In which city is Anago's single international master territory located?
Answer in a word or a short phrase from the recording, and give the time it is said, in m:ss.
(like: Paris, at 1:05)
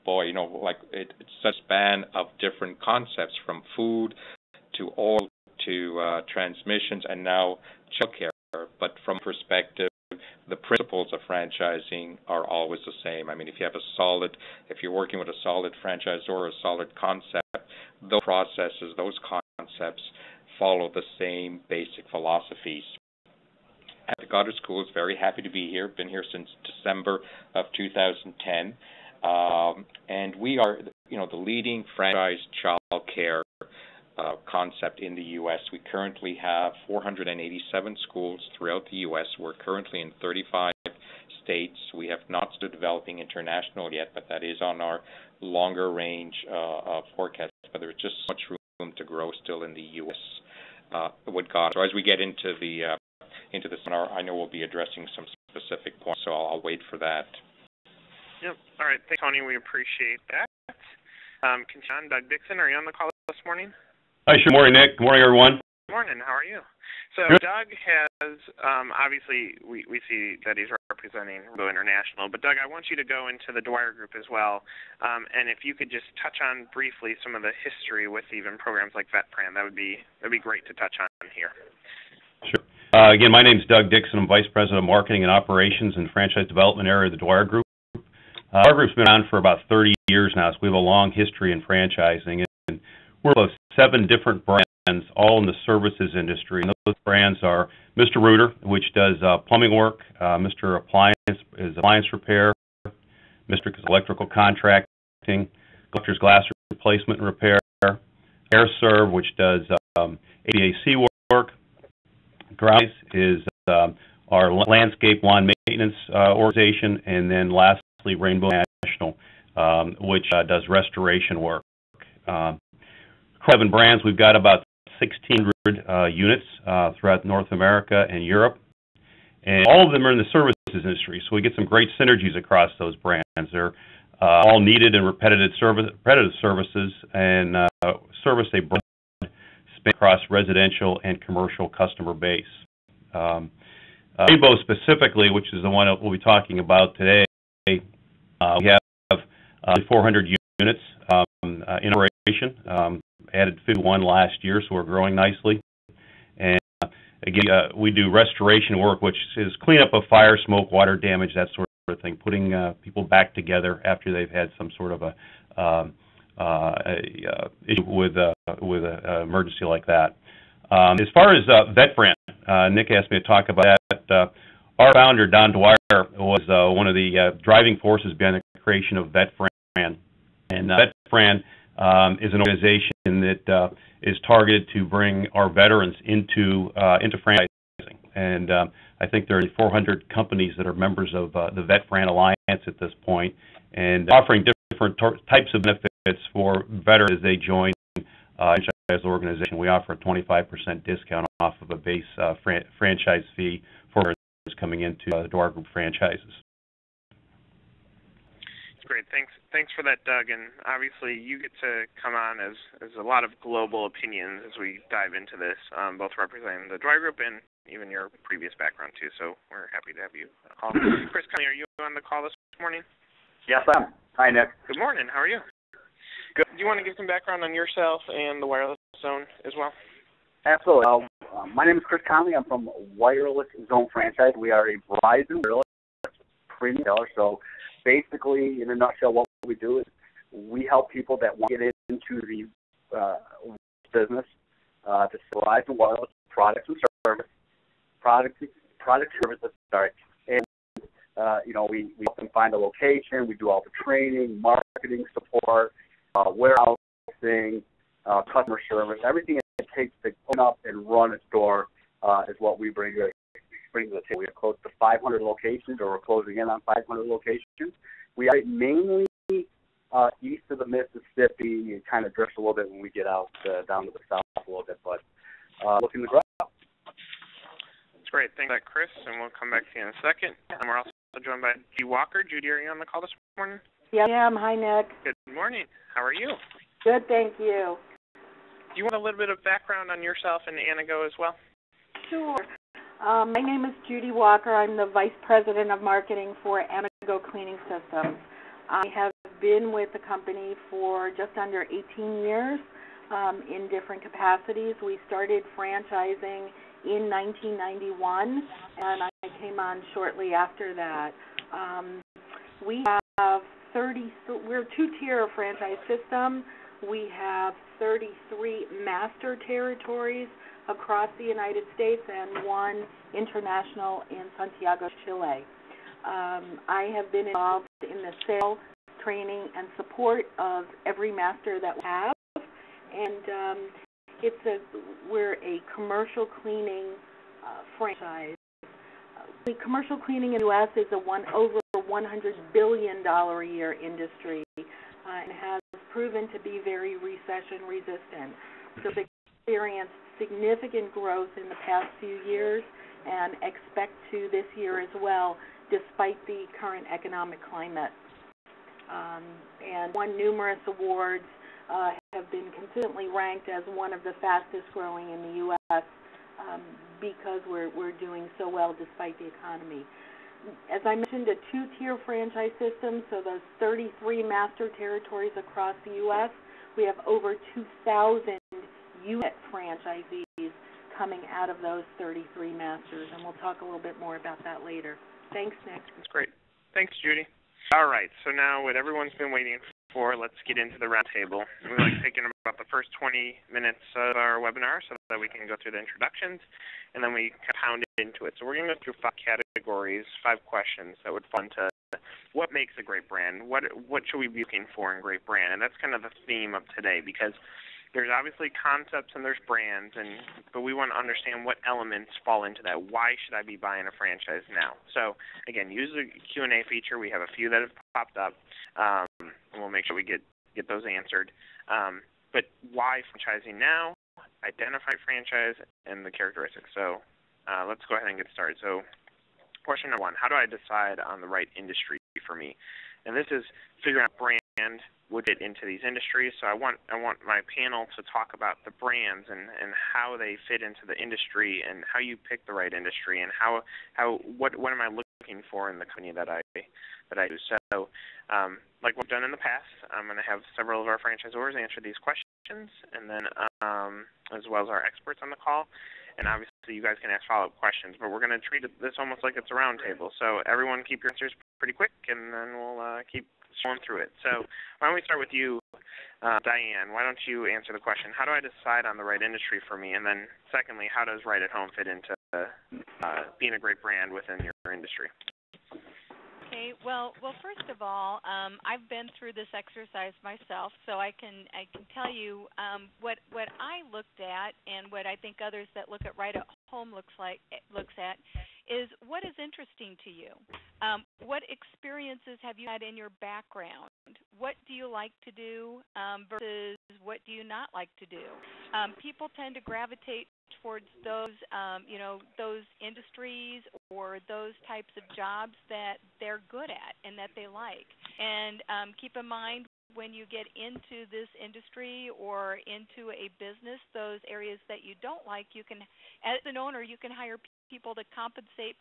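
Santiago, Chile, at 5:24.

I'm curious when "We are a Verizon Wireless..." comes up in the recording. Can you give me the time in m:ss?
3:54.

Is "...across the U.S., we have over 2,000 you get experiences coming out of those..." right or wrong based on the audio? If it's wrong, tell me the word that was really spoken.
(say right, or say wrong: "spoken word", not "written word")
wrong: "franchisees", not "experiences".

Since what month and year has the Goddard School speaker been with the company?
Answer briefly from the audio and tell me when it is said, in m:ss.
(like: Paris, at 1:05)
December 2010, at 0:26.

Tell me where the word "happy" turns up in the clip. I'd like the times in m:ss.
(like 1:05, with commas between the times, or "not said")
0:25, 3:39.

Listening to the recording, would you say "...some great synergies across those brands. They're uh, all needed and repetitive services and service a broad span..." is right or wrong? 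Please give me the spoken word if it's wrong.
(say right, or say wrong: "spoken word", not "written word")
right.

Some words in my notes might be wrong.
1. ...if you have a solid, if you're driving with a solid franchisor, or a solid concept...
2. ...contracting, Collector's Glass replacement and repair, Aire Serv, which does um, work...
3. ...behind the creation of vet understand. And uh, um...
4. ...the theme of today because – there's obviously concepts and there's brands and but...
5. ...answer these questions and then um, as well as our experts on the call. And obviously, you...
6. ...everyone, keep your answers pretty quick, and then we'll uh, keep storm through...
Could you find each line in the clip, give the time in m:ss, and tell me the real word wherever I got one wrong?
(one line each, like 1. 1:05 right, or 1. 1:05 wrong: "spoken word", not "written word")
1. 0:13 wrong: "working", not "driving"
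2. 1:44 right
3. 2:58 wrong: "brand", not "understand"
4. 6:46 right
5. 7:31 right
6. 7:40 right.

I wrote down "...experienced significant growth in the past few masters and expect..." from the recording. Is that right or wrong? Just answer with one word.
wrong.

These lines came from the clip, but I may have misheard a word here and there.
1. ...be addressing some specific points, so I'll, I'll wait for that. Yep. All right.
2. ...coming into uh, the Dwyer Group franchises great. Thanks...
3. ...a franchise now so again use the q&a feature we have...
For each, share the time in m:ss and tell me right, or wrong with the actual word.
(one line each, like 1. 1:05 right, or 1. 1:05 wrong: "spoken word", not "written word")
1. 0:54 right
2. 3:24 right
3. 6:53 right.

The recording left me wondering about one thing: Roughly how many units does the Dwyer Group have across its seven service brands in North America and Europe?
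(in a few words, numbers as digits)
1,600.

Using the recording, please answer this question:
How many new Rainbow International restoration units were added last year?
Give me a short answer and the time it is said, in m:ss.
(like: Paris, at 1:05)
51, at 2:33.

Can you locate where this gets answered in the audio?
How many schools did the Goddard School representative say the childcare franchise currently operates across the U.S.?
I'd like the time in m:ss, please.
0:36.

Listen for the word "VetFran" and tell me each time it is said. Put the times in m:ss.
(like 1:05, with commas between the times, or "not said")
1:19, 2:51, 3:11.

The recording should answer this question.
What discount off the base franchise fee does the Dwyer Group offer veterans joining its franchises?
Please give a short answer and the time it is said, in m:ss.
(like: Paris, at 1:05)
25%, at 3:19.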